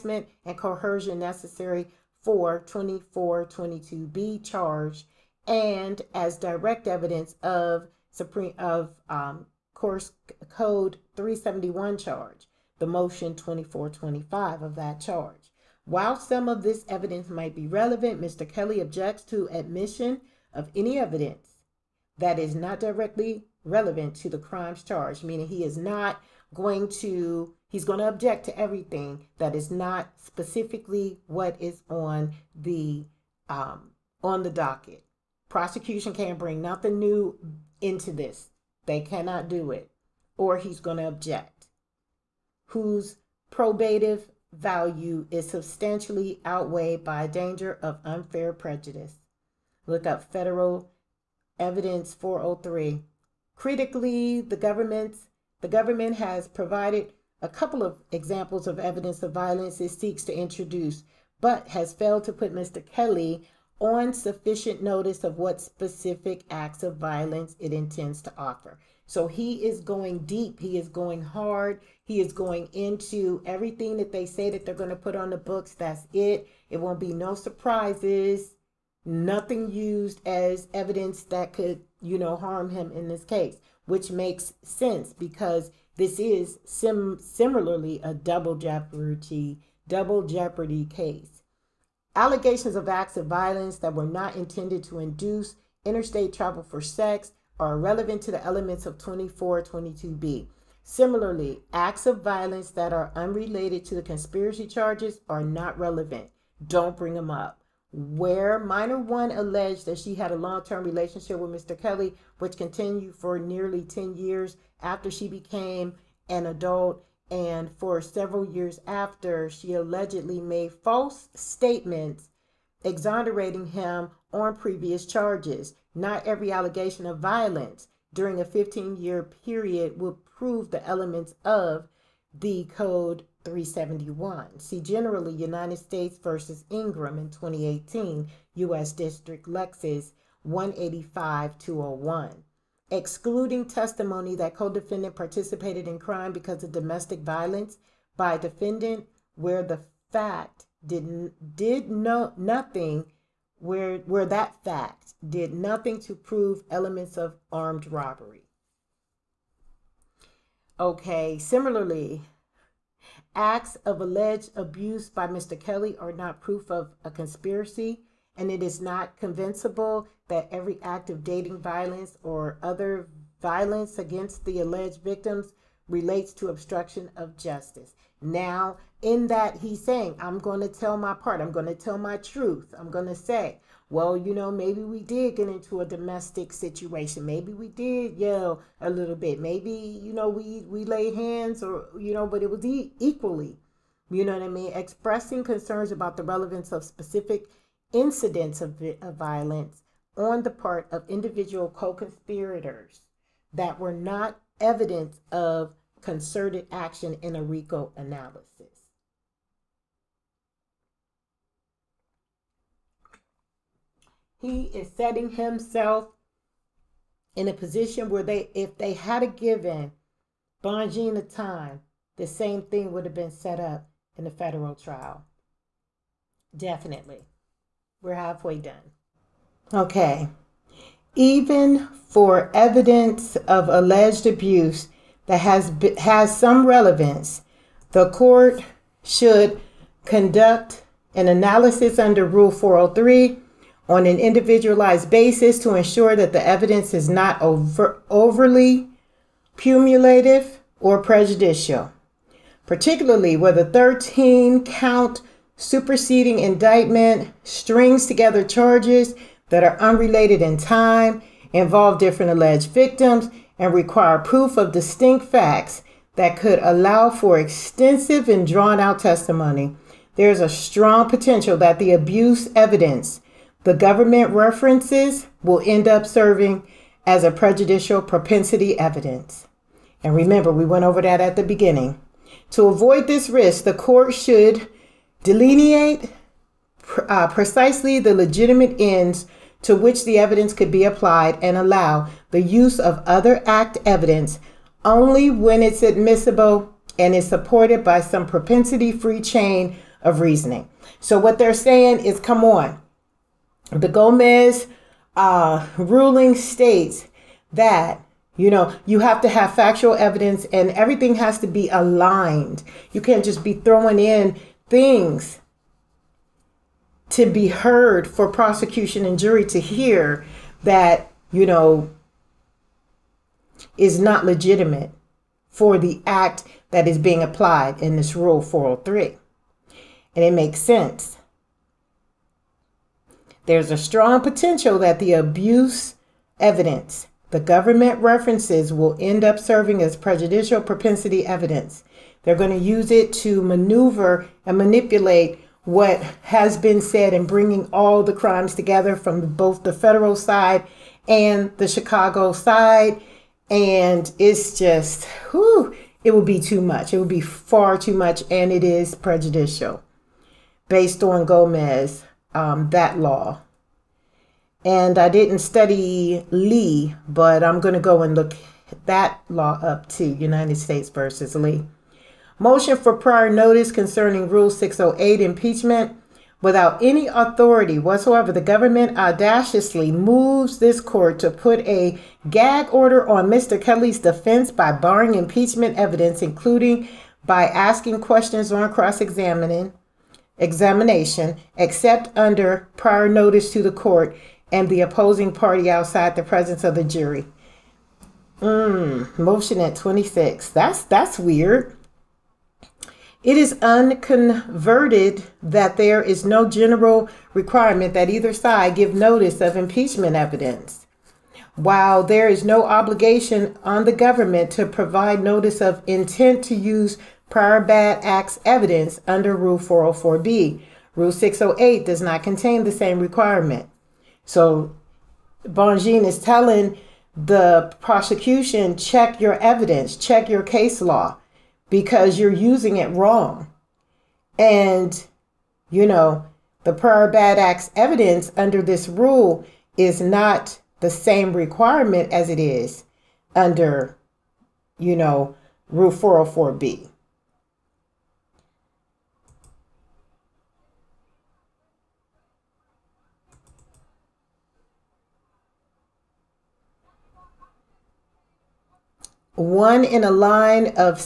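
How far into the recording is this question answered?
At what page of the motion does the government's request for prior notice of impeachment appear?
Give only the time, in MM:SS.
06:39.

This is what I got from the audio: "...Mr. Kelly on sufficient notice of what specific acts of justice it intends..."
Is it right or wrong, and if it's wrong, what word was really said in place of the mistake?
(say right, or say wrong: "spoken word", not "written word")
wrong: "violence", not "justice".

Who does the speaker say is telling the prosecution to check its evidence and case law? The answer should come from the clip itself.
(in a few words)
Bonjean.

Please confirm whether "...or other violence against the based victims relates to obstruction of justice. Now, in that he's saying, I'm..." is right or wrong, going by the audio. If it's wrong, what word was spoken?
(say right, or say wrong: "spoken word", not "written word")
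wrong: "alleged", not "based".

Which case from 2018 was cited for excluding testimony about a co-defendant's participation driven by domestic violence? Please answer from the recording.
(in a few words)
United States versus Ingram.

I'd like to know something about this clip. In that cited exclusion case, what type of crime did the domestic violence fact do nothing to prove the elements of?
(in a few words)
armed robbery.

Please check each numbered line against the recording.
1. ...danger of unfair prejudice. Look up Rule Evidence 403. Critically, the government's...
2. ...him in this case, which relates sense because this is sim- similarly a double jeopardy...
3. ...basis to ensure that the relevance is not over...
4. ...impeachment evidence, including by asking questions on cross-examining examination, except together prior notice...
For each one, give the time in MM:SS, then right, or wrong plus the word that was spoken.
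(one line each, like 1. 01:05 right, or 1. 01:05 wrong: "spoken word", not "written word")
1. 00:47 wrong: "Federal", not "Rule"
2. 01:22 wrong: "makes", not "relates"
3. 04:05 wrong: "evidence", not "relevance"
4. 06:25 wrong: "under", not "together".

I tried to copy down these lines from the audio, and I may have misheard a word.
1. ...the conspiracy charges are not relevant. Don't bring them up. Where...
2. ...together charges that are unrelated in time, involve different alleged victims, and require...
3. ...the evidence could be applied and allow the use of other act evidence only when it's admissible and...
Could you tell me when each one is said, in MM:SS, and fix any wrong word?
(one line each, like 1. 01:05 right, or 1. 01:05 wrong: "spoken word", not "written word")
1. 01:43 right
2. 04:18 right
3. 04:50 right.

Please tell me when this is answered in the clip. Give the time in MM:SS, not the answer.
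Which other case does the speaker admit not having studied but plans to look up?
06:10.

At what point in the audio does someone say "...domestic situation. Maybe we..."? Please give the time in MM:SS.
03:05.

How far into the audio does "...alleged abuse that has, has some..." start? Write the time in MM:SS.
03:53.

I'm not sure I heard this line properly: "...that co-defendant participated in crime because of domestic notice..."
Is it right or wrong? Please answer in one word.
wrong.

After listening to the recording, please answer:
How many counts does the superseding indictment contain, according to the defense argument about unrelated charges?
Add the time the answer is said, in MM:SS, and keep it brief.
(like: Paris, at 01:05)
13, at 04:13.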